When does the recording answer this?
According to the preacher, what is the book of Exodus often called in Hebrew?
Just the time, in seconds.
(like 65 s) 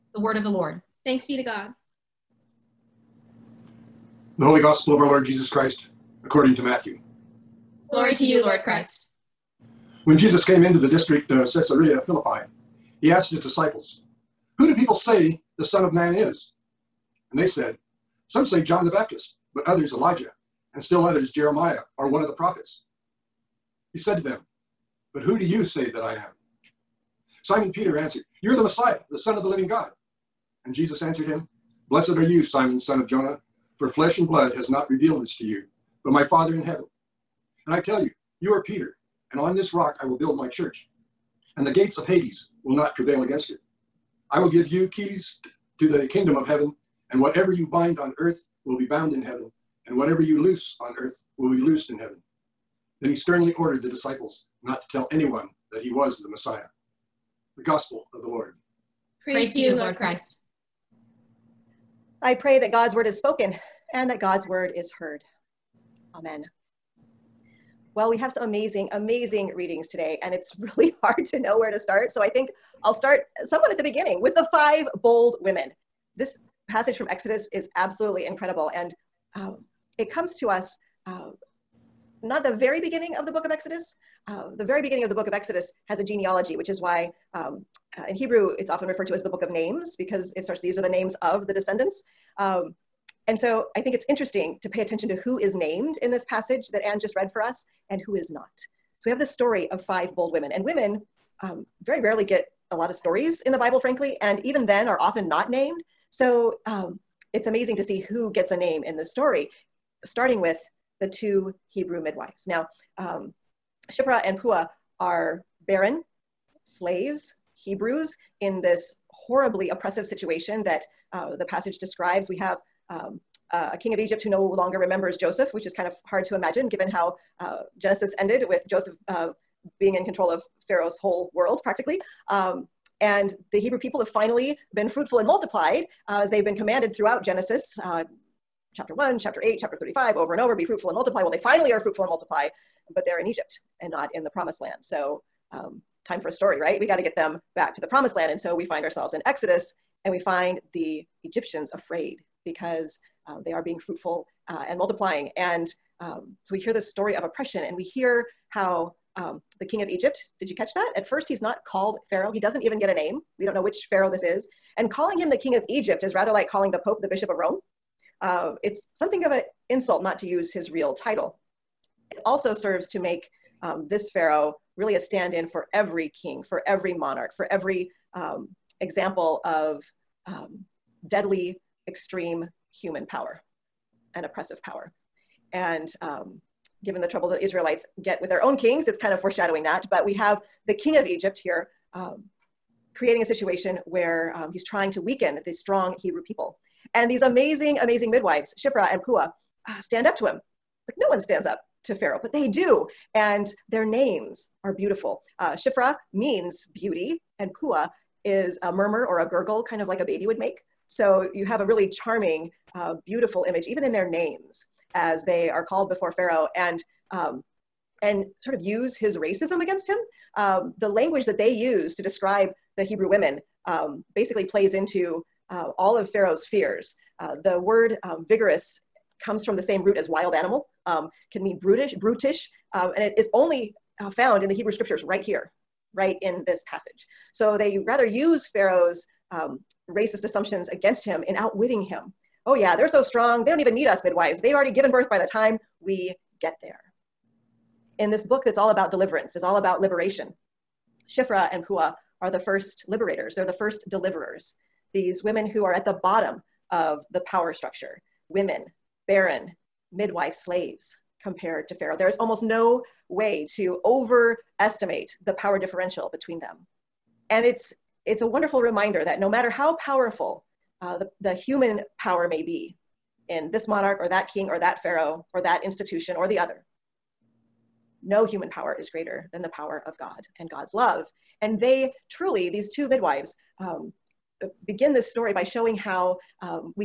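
89 s.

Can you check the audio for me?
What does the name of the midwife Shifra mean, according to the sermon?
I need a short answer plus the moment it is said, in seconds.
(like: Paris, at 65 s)
Beauty, at 206 s.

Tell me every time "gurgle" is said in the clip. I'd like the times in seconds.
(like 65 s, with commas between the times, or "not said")
209 s.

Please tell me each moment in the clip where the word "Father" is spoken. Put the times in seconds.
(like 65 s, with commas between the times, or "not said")
36 s.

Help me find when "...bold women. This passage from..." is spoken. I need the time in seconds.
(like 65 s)
75 s.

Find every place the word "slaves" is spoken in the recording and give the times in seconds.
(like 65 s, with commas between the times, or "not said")
116 s, 260 s.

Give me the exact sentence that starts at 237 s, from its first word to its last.
So they rather use Pharaoh's um, racist assumptions against him in outwitting him.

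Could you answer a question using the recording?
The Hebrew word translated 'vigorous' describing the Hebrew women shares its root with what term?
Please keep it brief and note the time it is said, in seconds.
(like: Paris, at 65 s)
Wild animal, at 230 s.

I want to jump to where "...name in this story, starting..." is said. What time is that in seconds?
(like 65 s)
108 s.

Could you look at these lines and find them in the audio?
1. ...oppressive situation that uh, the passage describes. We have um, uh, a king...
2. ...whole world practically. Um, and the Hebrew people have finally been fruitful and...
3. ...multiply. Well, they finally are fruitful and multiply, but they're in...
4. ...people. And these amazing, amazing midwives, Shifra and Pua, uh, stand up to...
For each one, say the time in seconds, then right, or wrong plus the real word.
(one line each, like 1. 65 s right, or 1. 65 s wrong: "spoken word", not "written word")
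1. 119 s right
2. 130 s right
3. 140 s right
4. 196 s right.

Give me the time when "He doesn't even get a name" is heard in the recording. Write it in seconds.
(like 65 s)
162 s.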